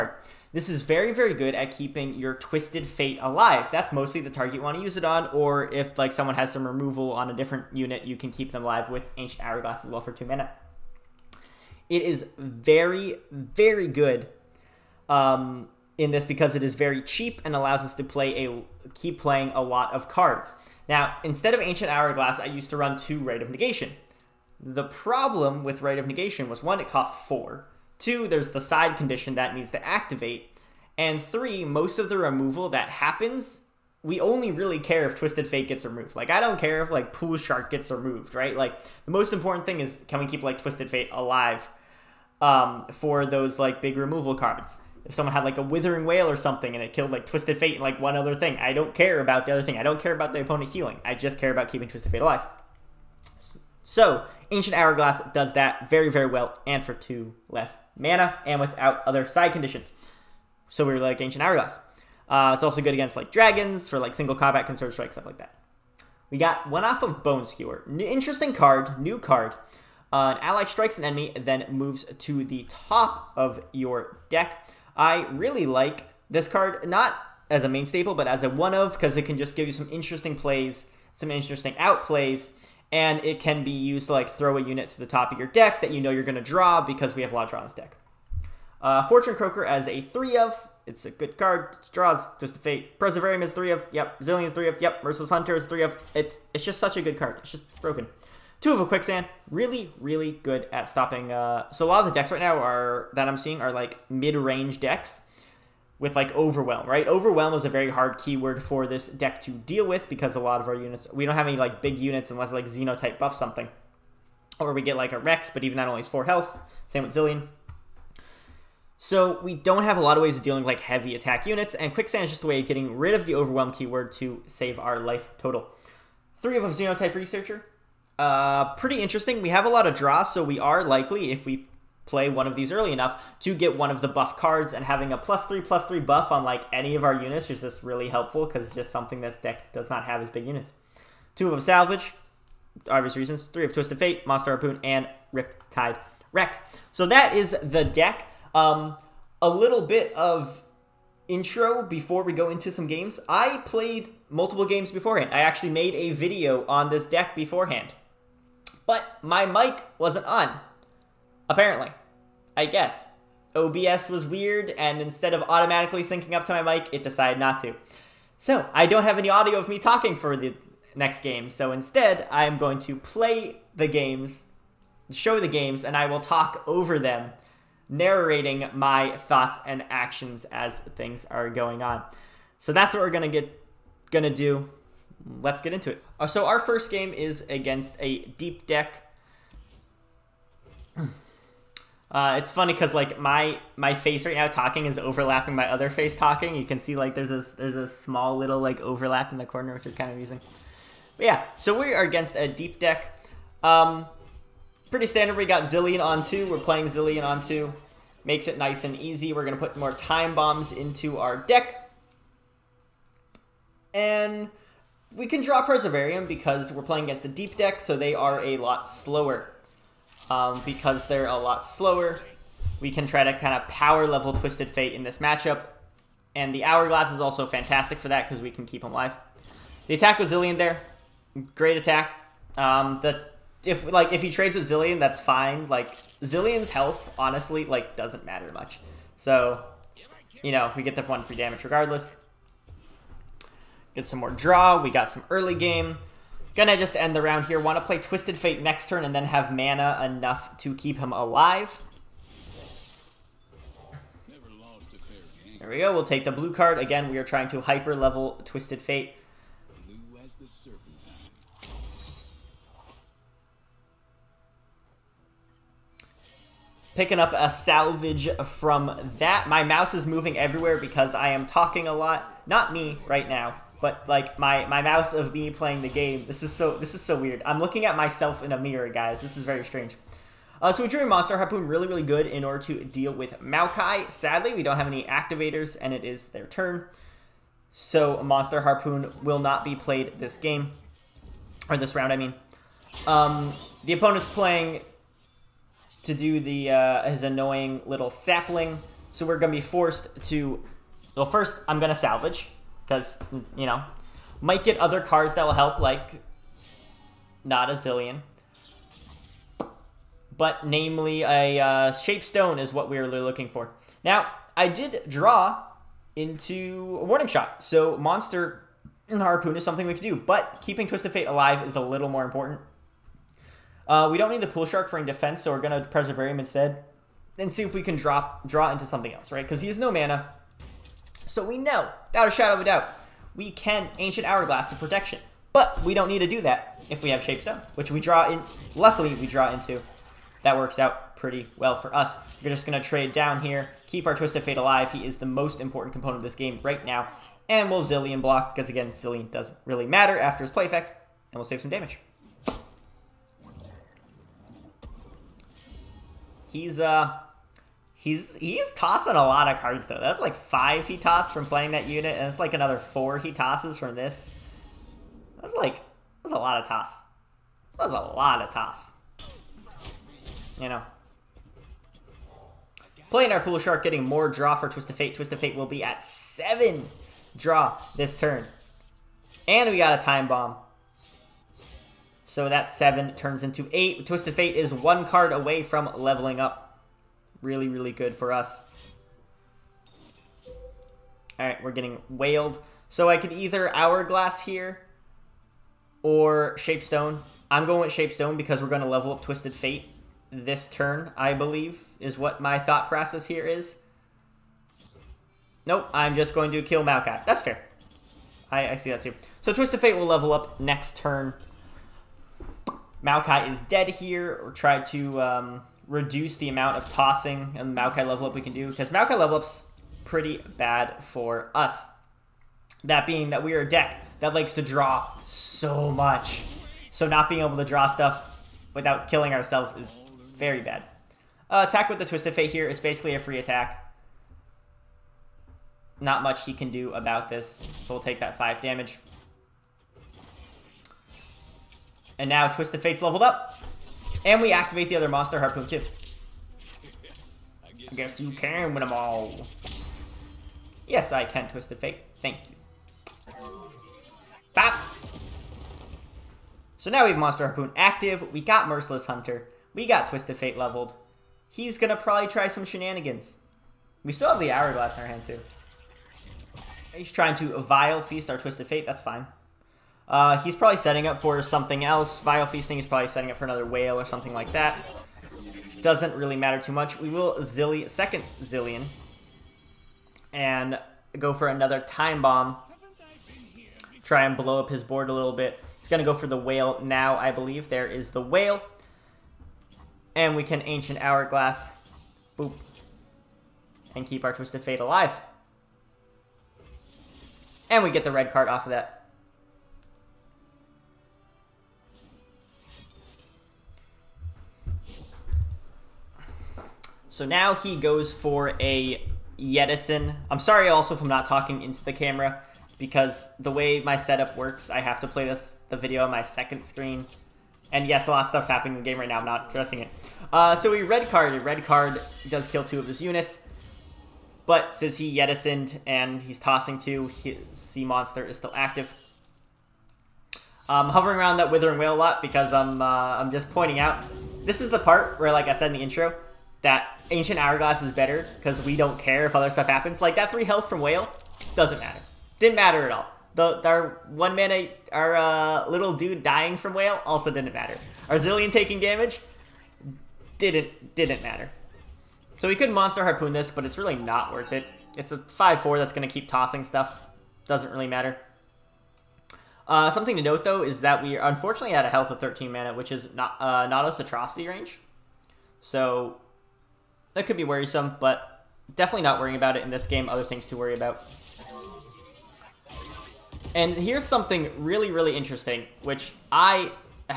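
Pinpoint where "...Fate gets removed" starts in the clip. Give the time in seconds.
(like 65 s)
35 s.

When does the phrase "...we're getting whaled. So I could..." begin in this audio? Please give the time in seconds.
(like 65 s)
391 s.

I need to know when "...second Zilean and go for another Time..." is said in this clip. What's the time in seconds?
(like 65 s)
477 s.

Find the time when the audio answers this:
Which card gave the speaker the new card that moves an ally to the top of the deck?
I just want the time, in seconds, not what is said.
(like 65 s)
67 s.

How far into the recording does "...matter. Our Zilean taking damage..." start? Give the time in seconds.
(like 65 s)
547 s.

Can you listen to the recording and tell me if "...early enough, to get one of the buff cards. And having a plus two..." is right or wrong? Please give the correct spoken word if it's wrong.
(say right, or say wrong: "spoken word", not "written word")
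wrong: "three", not "two".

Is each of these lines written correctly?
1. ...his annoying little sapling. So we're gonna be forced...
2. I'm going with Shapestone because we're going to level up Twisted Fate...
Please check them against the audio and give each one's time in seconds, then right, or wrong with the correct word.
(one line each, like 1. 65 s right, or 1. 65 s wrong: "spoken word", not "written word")
1. 297 s right
2. 397 s right.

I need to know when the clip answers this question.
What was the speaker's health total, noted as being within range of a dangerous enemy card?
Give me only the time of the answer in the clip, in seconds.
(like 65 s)
562 s.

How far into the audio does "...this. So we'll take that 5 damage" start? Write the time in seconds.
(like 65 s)
437 s.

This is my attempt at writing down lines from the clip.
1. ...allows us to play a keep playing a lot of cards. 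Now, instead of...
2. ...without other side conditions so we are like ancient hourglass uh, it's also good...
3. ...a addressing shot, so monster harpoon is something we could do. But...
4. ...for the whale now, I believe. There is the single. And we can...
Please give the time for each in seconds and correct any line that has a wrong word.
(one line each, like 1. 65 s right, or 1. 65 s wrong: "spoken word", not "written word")
1. 17 s right
2. 58 s right
3. 317 s wrong: "warning", not "addressing"
4. 486 s wrong: "whale", not "single".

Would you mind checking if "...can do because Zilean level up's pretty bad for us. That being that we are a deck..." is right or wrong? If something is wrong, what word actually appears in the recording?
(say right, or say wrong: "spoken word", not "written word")
wrong: "Maokai", not "Zilean".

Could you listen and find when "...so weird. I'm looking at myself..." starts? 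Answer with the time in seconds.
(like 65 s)
277 s.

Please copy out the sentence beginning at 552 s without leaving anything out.
So we could Monster Harpoon this, but it's really not worth it.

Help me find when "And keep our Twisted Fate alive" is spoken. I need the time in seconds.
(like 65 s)
493 s.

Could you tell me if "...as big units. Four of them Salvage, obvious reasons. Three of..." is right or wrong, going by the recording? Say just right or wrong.
wrong.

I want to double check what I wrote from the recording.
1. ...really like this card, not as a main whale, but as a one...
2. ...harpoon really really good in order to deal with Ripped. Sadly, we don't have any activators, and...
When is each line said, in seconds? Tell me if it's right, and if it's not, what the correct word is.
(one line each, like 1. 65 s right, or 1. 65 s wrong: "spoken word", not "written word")
1. 75 s wrong: "staple", not "whale"
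2. 281 s wrong: "Maokai", not "Ripped".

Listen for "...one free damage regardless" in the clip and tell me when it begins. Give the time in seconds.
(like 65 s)
241 s.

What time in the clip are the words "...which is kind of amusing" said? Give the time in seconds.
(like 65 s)
199 s.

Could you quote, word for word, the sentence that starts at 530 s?
I'm hovering around that Withering Wail a lot because I'm, uh, I'm just pointing out.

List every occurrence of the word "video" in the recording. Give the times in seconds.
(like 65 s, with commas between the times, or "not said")
156 s, 515 s.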